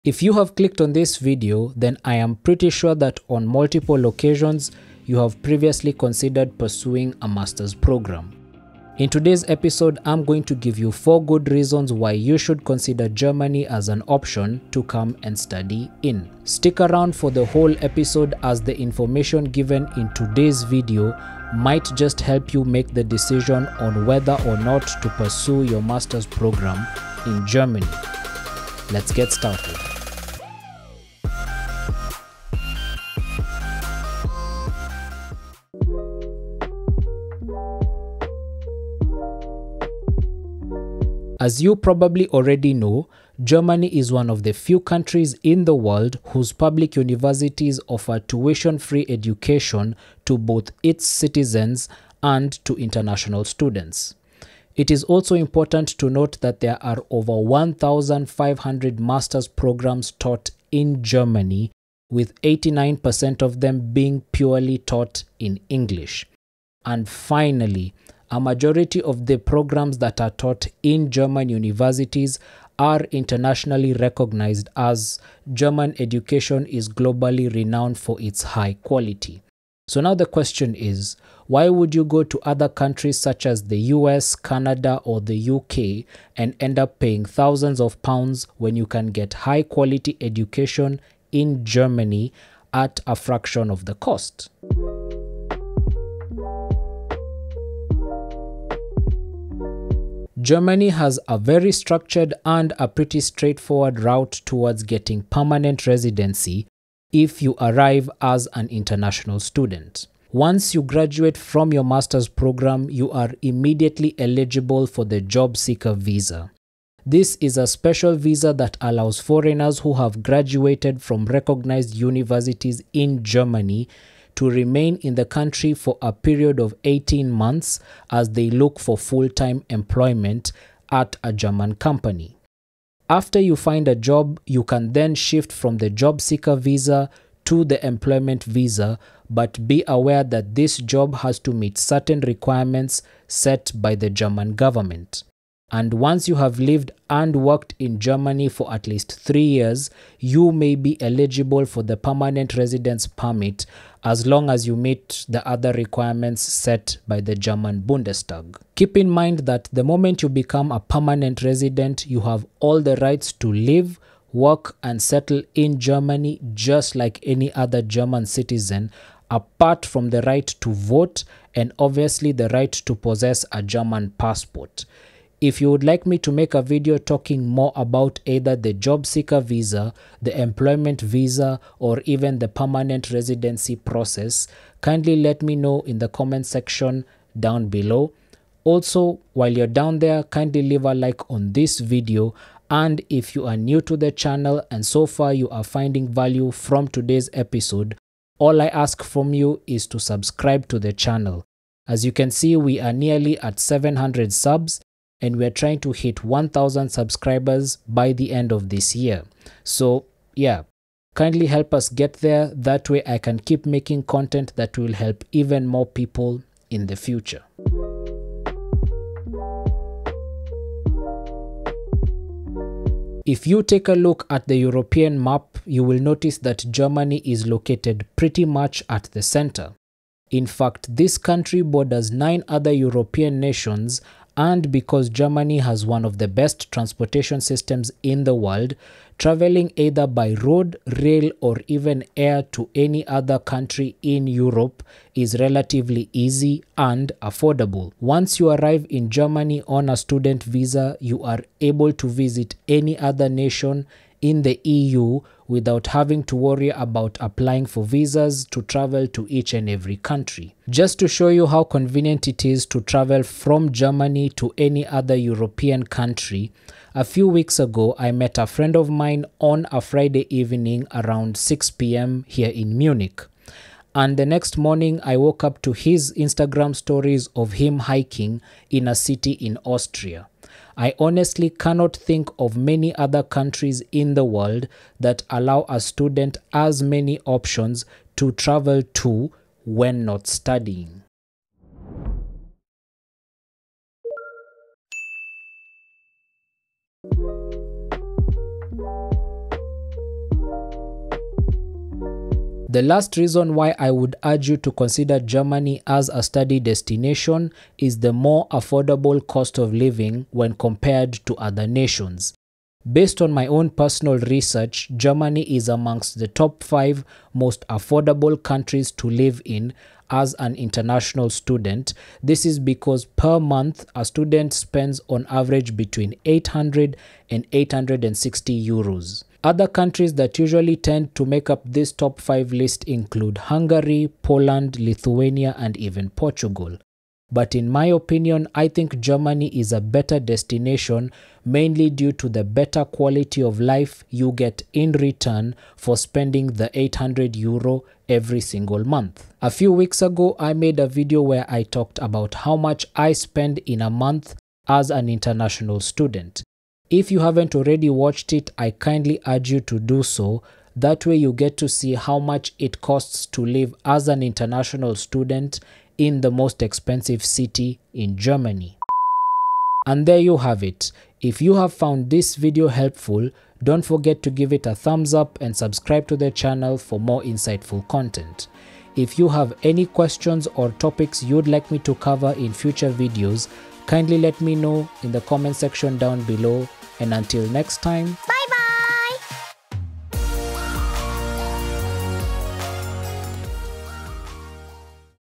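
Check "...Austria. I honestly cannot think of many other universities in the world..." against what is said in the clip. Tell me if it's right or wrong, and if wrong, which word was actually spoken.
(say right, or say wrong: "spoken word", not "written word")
wrong: "countries", not "universities".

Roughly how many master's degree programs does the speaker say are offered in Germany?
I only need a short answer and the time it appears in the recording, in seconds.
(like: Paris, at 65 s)
over 1,500, at 57 s.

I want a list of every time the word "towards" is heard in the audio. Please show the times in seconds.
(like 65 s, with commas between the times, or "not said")
104 s.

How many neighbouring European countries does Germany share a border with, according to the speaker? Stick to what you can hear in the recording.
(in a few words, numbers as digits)
nine.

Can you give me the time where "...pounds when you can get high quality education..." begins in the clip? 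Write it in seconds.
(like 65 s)
88 s.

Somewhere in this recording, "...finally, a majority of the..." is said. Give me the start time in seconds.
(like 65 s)
67 s.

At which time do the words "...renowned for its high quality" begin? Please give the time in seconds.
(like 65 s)
77 s.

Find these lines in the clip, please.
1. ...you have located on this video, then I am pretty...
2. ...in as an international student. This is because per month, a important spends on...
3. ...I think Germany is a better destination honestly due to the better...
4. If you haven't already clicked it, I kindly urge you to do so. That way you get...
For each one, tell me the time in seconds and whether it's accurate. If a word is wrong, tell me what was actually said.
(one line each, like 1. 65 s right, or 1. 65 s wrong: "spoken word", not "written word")
1. 0 s wrong: "clicked", not "located"
2. 319 s wrong: "student", not "important"
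3. 338 s wrong: "mainly", not "honestly"
4. 356 s wrong: "watched", not "clicked".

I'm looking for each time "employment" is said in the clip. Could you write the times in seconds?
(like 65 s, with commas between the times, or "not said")
129 s, 137 s, 180 s.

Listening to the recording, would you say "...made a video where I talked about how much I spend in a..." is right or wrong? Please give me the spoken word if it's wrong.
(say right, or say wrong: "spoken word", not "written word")
right.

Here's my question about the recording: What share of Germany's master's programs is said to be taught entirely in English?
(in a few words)
89%.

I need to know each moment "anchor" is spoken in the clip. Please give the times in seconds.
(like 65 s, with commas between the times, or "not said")
not said.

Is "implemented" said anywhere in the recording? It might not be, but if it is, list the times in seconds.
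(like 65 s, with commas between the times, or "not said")
not said.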